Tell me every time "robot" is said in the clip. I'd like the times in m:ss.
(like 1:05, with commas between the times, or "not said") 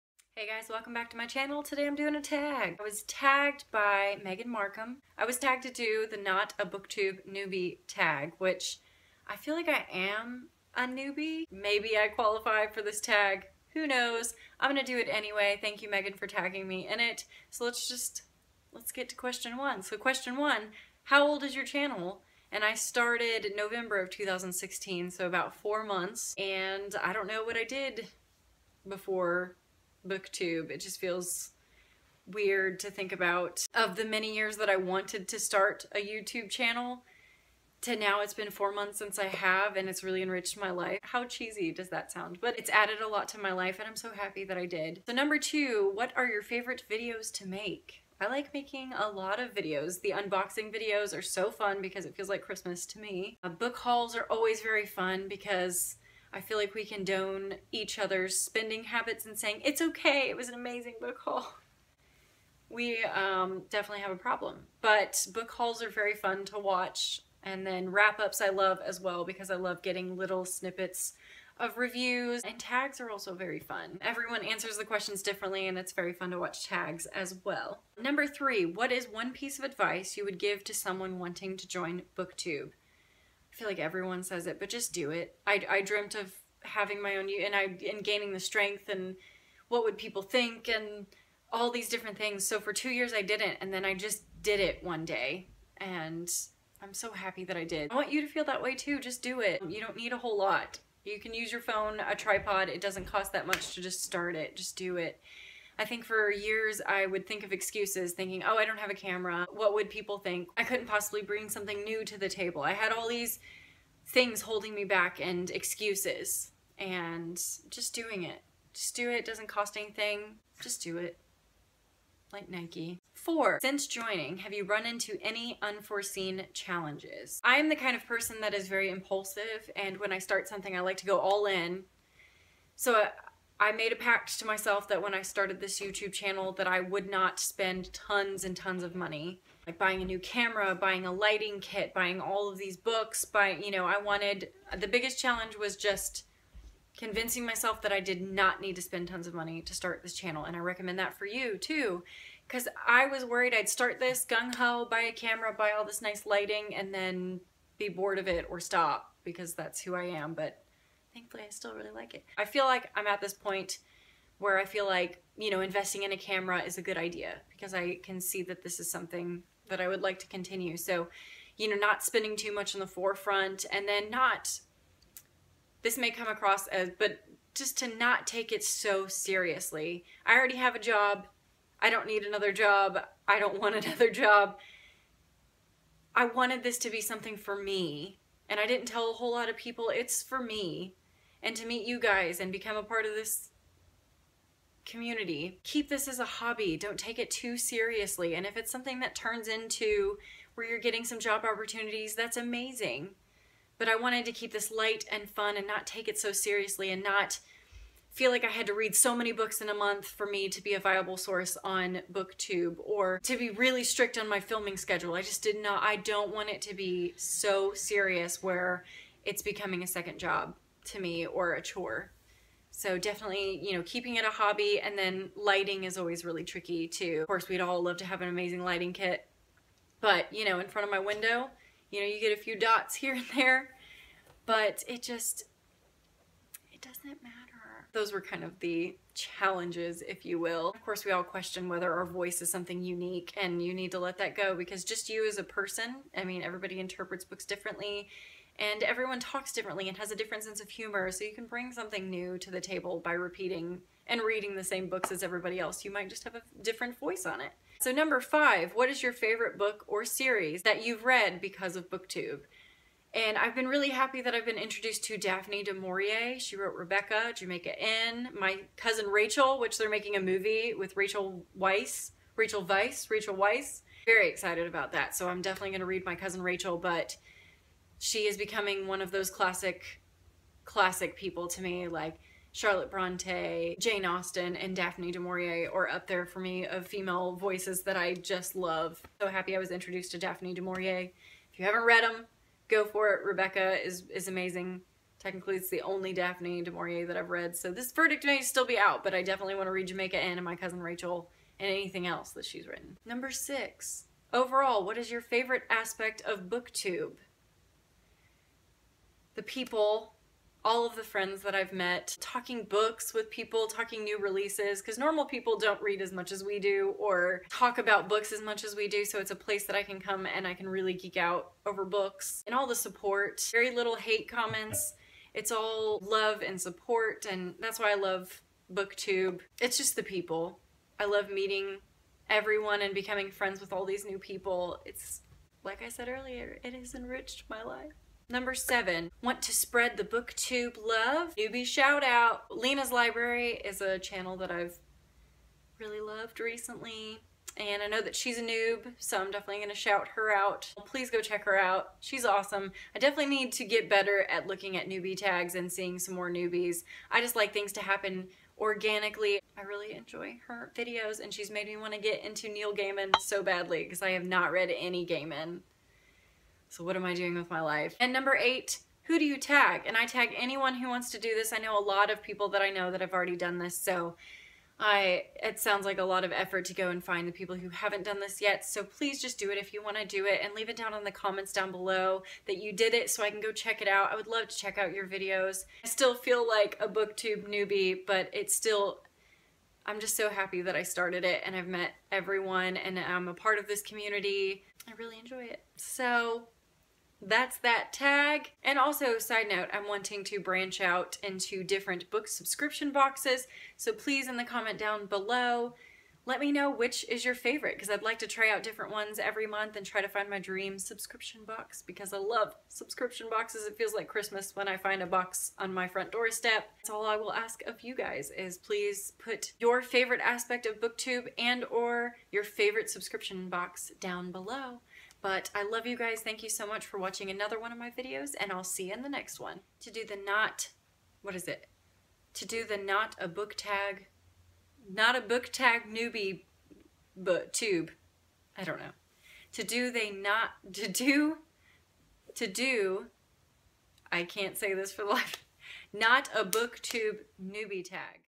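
not said.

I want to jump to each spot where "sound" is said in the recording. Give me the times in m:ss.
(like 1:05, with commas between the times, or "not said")
0:42, 6:15.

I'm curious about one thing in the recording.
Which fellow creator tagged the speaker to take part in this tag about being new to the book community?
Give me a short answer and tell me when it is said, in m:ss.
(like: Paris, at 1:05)
Megan Markham, at 0:04.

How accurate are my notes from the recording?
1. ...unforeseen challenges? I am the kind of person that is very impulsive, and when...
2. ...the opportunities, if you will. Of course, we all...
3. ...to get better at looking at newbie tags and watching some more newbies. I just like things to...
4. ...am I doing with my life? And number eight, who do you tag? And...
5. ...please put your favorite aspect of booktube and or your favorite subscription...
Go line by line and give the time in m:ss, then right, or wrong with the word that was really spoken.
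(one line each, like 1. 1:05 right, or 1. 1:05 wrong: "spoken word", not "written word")
1. 2:05 right
2. 3:58 wrong: "challenges", not "opportunities"
3. 5:53 wrong: "seeing", not "watching"
4. 6:06 right
5. 6:58 right.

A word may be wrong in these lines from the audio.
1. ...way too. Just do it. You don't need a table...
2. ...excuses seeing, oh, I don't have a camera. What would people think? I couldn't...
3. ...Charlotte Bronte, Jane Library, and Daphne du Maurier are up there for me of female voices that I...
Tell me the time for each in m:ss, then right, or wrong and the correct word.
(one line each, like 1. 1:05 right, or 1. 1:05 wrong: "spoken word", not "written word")
1. 1:38 wrong: "whole", not "table"
2. 1:47 wrong: "thinking", not "seeing"
3. 4:42 wrong: "Austen", not "Library".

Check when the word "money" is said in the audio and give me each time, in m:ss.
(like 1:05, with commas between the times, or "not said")
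2:18, 2:29.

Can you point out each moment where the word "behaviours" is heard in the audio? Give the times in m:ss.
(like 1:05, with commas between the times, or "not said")
not said.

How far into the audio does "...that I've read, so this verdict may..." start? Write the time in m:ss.
4:57.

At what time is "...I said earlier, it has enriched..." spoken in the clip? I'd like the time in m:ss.
5:35.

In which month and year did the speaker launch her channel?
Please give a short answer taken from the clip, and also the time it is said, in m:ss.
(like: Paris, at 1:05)
November 2016, at 0:23.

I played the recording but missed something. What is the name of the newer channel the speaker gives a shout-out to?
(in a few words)
Liene's Library.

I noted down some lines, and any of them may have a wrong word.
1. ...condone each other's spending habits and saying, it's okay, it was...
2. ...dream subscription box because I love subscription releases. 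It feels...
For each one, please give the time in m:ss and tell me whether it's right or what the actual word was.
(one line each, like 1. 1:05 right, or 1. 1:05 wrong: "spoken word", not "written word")
1. 0:56 right
2. 6:50 wrong: "boxes", not "releases".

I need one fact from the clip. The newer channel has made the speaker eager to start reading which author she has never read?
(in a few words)
Neil Gaiman.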